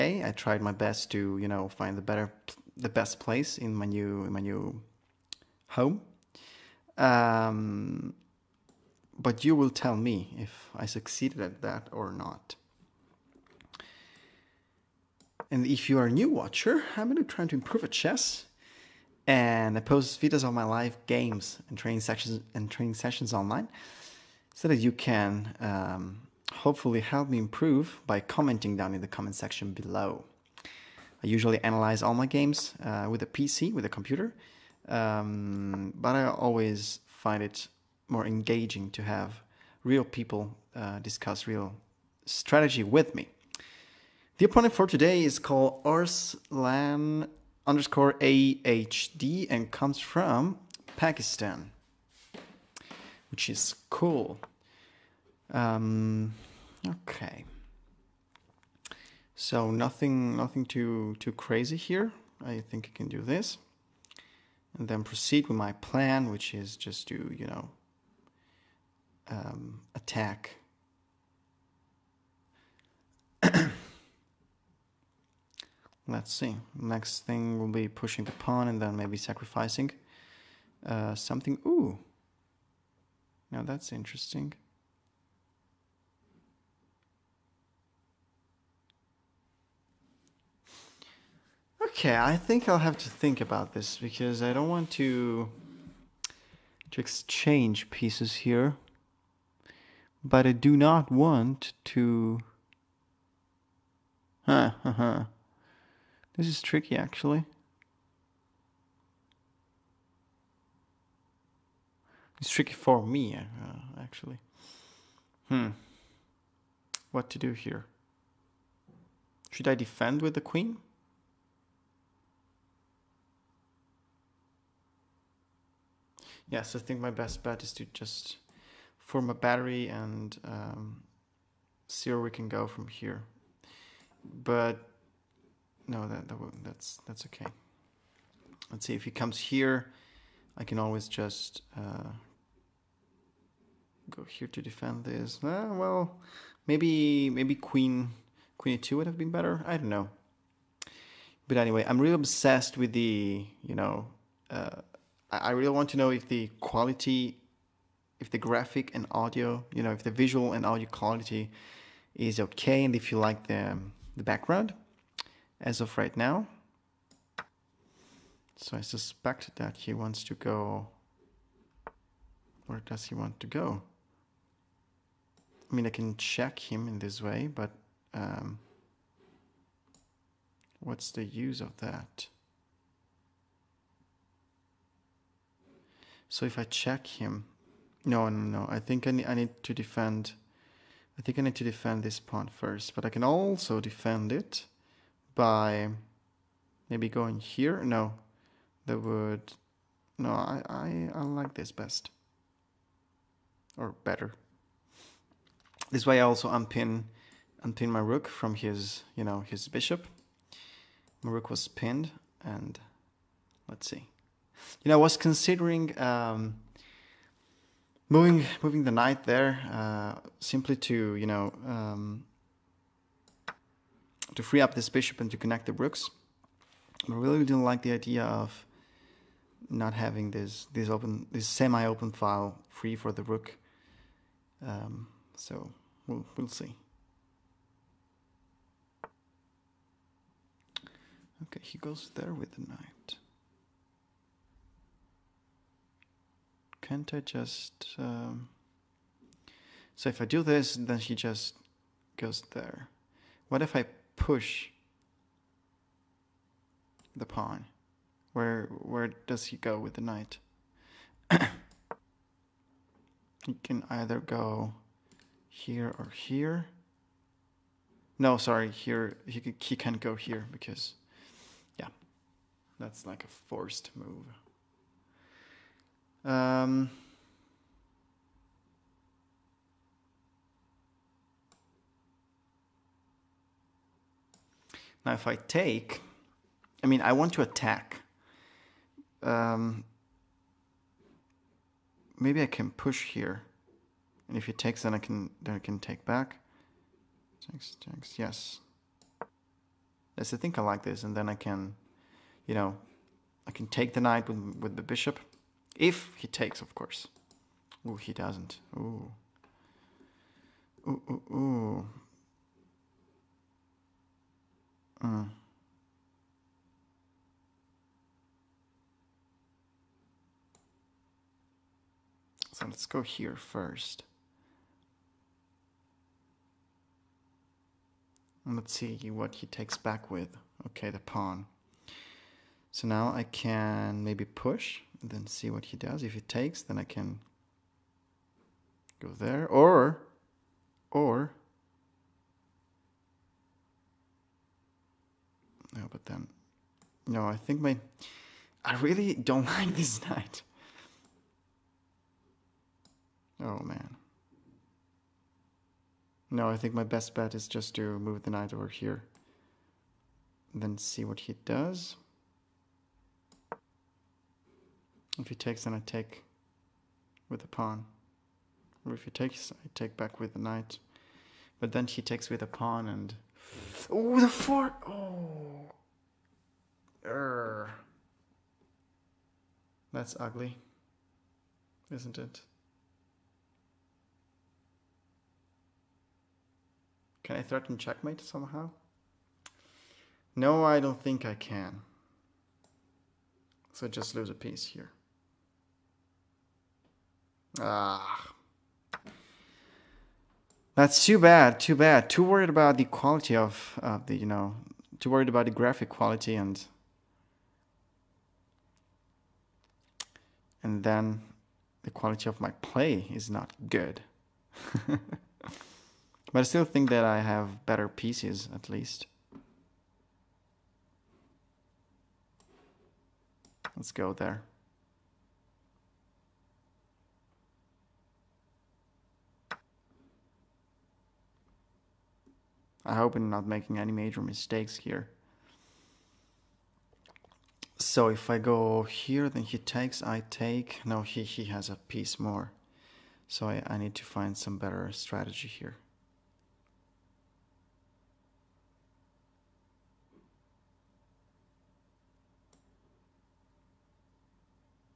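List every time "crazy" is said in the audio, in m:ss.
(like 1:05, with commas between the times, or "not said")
1:01.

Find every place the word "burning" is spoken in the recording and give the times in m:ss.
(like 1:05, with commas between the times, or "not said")
not said.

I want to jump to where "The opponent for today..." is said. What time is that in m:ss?
0:44.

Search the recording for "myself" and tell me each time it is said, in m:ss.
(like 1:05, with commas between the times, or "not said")
not said.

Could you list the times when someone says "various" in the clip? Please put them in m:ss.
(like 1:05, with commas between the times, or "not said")
not said.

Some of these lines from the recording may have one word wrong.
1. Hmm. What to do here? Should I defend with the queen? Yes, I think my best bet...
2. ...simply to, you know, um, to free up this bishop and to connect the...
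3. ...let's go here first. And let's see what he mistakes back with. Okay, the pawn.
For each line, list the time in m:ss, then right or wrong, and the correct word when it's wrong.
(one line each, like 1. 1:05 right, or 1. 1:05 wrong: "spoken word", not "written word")
1. 1:55 right
2. 3:40 right
3. 5:22 wrong: "takes", not "mistakes".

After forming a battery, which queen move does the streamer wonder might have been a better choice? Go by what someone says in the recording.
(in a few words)
Queen e2.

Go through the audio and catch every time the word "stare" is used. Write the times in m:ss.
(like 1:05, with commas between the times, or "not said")
not said.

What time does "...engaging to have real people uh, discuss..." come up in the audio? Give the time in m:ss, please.
0:38.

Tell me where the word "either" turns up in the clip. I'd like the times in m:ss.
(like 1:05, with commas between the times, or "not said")
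4:23.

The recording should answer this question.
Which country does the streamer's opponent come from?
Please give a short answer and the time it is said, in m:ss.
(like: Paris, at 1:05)
Pakistan, at 0:50.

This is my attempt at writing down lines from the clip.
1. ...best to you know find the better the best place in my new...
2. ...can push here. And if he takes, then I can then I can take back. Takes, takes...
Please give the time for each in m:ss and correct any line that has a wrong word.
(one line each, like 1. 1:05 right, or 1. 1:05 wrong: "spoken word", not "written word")
1. 0:00 right
2. 4:52 right.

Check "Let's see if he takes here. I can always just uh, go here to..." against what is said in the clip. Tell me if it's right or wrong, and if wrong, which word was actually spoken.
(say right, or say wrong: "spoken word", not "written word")
wrong: "comes", not "takes".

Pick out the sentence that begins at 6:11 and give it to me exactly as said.
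But then he takes with a pawn and Oh, the fart.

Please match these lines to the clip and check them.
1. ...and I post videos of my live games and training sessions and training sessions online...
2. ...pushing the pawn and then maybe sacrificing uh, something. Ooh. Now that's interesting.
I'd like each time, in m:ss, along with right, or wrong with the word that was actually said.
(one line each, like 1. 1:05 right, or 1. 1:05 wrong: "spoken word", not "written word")
1. 0:19 right
2. 1:17 right.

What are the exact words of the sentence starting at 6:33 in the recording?
So just lose a piece here.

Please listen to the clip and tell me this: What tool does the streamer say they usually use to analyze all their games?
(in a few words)
A computer.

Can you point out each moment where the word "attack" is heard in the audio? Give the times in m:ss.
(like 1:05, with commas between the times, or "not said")
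1:09, 4:47.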